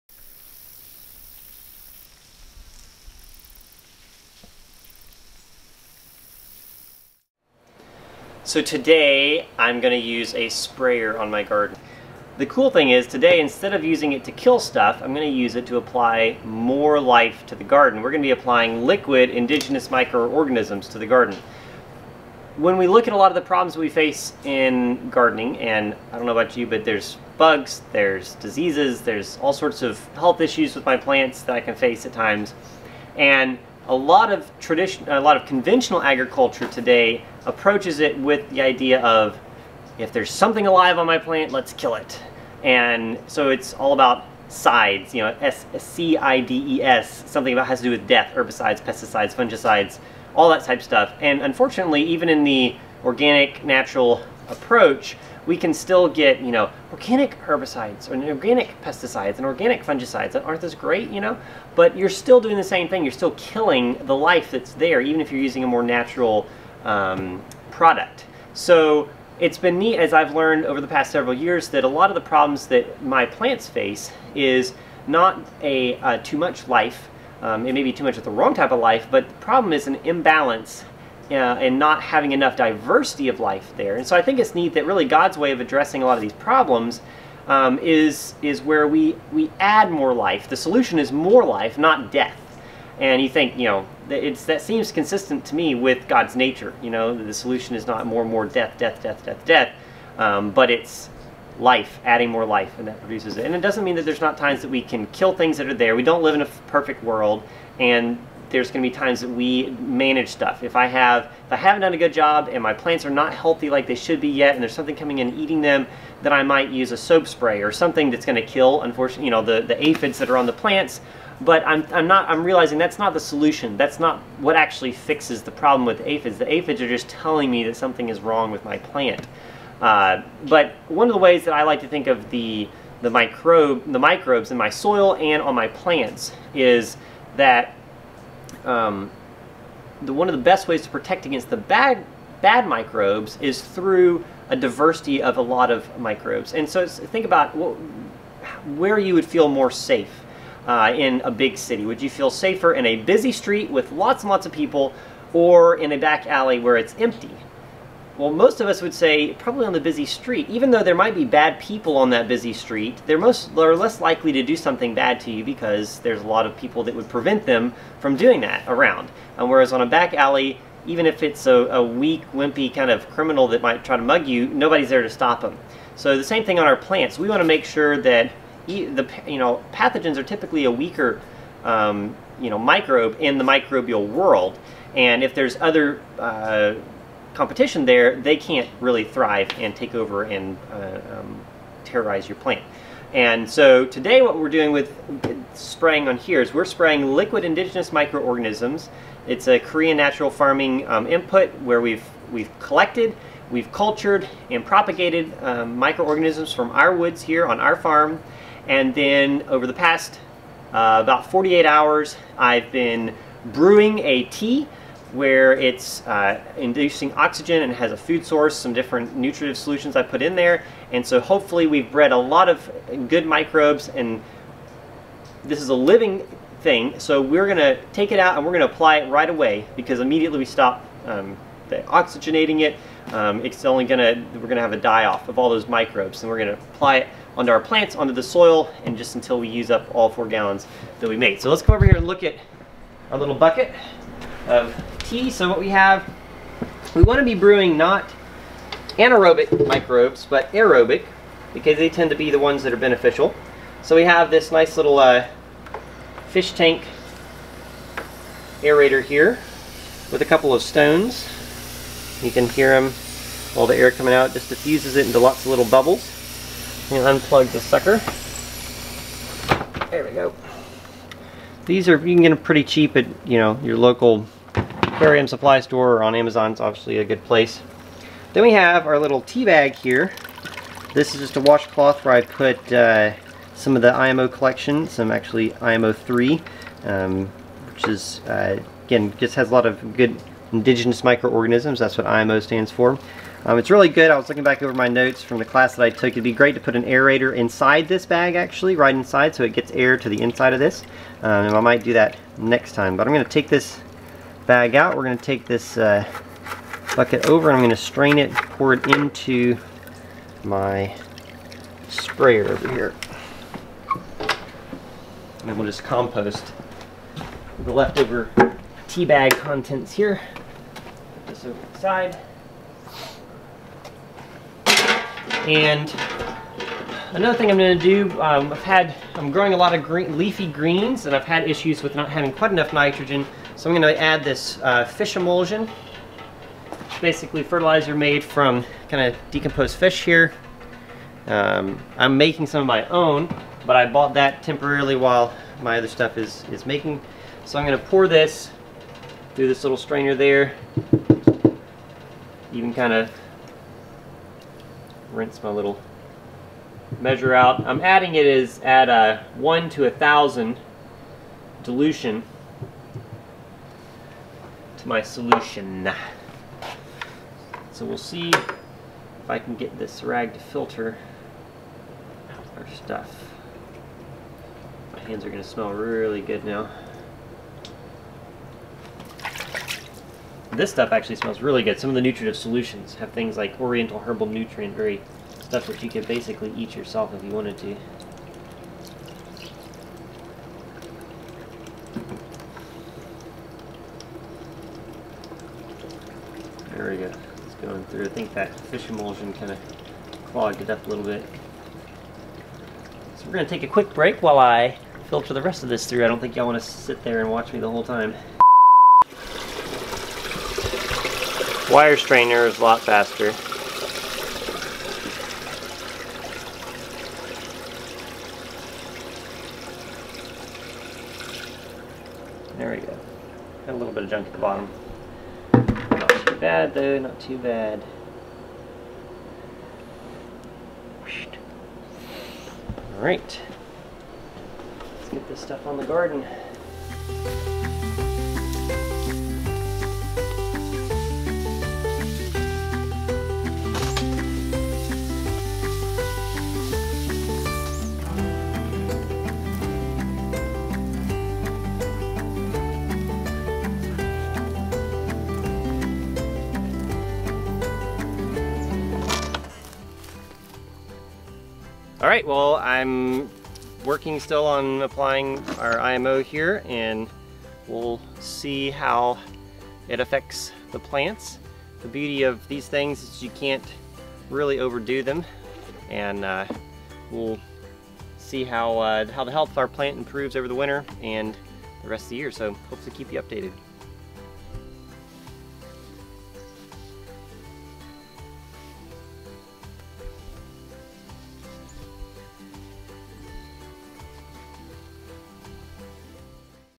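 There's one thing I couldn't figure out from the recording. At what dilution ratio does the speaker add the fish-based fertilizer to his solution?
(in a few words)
1 to 1,000.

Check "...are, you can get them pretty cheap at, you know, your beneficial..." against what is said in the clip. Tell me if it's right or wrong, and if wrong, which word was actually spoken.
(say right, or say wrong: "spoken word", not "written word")
wrong: "local", not "beneficial".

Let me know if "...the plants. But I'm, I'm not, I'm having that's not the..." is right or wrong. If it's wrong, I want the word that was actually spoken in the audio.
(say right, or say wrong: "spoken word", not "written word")
wrong: "realizing", not "having".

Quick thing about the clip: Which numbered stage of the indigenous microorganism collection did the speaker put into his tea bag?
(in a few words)
IMO 3.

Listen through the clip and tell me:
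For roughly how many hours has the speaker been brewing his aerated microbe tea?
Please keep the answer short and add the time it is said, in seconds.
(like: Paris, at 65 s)
48, at 211 s.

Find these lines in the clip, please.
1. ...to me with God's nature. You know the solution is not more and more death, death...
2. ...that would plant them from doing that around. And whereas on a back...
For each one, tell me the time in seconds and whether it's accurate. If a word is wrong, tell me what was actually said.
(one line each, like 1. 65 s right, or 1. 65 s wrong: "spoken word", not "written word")
1. 95 s right
2. 166 s wrong: "prevent", not "plant".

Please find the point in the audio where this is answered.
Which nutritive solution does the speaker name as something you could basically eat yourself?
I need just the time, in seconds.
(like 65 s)
383 s.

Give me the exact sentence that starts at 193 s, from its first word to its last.
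And so today what we're doing with spraying on here is we're spraying liquid indigenous microorganisms.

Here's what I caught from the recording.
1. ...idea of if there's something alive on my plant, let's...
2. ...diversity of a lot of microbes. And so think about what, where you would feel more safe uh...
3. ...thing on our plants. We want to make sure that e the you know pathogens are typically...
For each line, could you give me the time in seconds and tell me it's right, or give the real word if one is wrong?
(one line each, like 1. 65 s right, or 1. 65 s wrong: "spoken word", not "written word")
1. 38 s right
2. 144 s right
3. 176 s right.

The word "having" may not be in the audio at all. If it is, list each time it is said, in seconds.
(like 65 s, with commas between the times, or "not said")
82 s, 332 s.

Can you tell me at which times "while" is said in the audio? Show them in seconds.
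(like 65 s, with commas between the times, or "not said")
344 s, 404 s.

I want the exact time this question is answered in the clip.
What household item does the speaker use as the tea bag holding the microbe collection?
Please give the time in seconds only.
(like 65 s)
281 s.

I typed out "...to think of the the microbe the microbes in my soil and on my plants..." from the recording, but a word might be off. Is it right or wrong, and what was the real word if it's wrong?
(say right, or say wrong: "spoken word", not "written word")
right.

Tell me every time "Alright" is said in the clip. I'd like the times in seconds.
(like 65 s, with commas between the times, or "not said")
432 s.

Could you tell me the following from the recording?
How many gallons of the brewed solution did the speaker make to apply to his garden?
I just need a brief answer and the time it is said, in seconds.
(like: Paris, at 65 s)
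4, at 240 s.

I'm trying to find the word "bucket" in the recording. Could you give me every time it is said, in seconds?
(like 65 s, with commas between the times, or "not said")
243 s, 306 s.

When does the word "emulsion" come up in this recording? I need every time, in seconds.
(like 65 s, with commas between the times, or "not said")
335 s, 398 s.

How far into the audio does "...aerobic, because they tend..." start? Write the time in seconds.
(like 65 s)
250 s.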